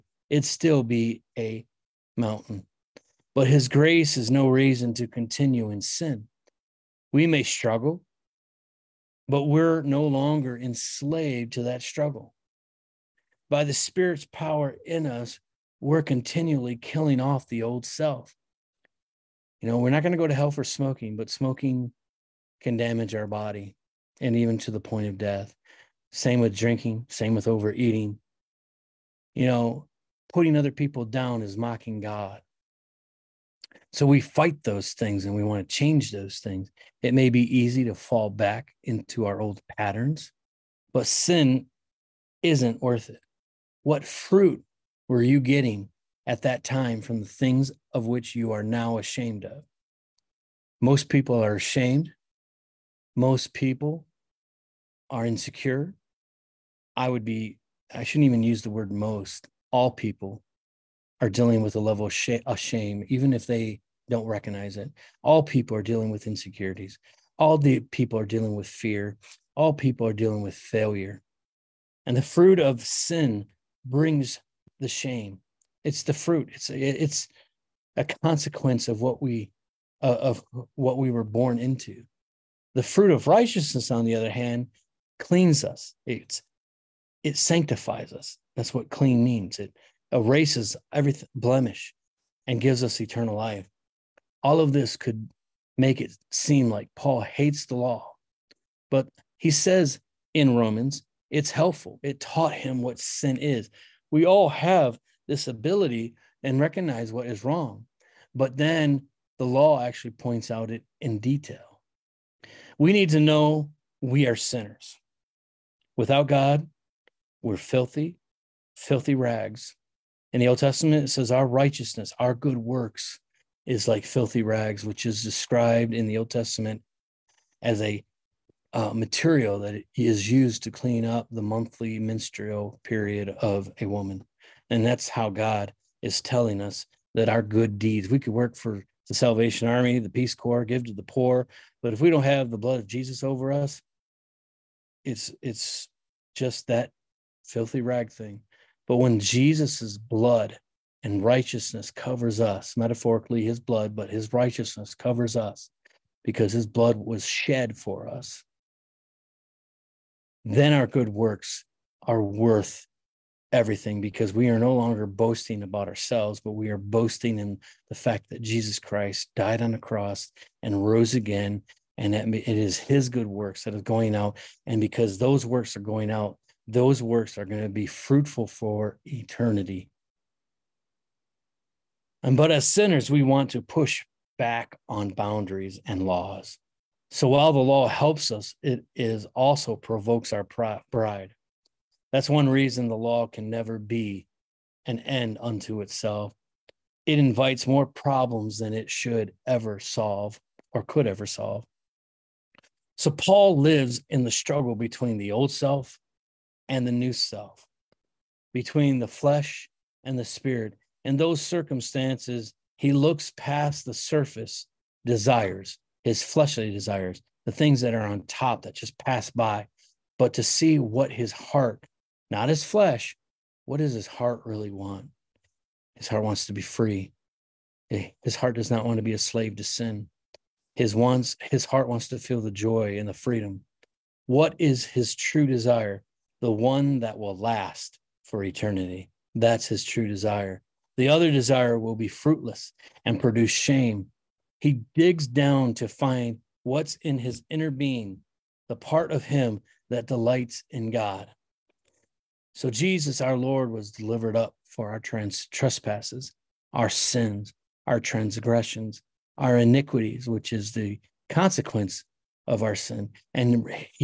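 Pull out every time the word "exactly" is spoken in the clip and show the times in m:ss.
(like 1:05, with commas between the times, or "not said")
not said.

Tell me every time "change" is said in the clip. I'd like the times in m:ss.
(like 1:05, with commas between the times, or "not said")
0:35.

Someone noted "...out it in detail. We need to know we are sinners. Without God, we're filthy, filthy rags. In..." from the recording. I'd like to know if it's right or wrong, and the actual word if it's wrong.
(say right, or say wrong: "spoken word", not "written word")
right.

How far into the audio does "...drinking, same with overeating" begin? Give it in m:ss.
0:26.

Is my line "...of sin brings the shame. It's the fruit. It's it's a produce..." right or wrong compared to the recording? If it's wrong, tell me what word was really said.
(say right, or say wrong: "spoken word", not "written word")
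wrong: "consequence", not "produce".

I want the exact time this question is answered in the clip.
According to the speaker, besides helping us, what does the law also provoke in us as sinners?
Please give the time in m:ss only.
3:10.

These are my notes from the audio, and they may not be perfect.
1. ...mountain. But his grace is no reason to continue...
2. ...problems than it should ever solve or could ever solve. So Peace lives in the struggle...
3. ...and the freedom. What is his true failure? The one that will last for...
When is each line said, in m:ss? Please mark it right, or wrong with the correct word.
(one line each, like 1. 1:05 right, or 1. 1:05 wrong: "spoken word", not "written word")
1. 0:02 right
2. 3:17 wrong: "Paul", not "Peace"
3. 3:52 wrong: "desire", not "failure".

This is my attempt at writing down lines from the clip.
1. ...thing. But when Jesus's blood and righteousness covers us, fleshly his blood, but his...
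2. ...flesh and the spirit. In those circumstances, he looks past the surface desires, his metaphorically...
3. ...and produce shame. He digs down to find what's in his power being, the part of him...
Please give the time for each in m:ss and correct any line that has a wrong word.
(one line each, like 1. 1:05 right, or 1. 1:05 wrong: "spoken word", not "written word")
1. 2:28 wrong: "metaphorically", not "fleshly"
2. 3:29 wrong: "fleshly", not "metaphorically"
3. 4:03 wrong: "inner", not "power".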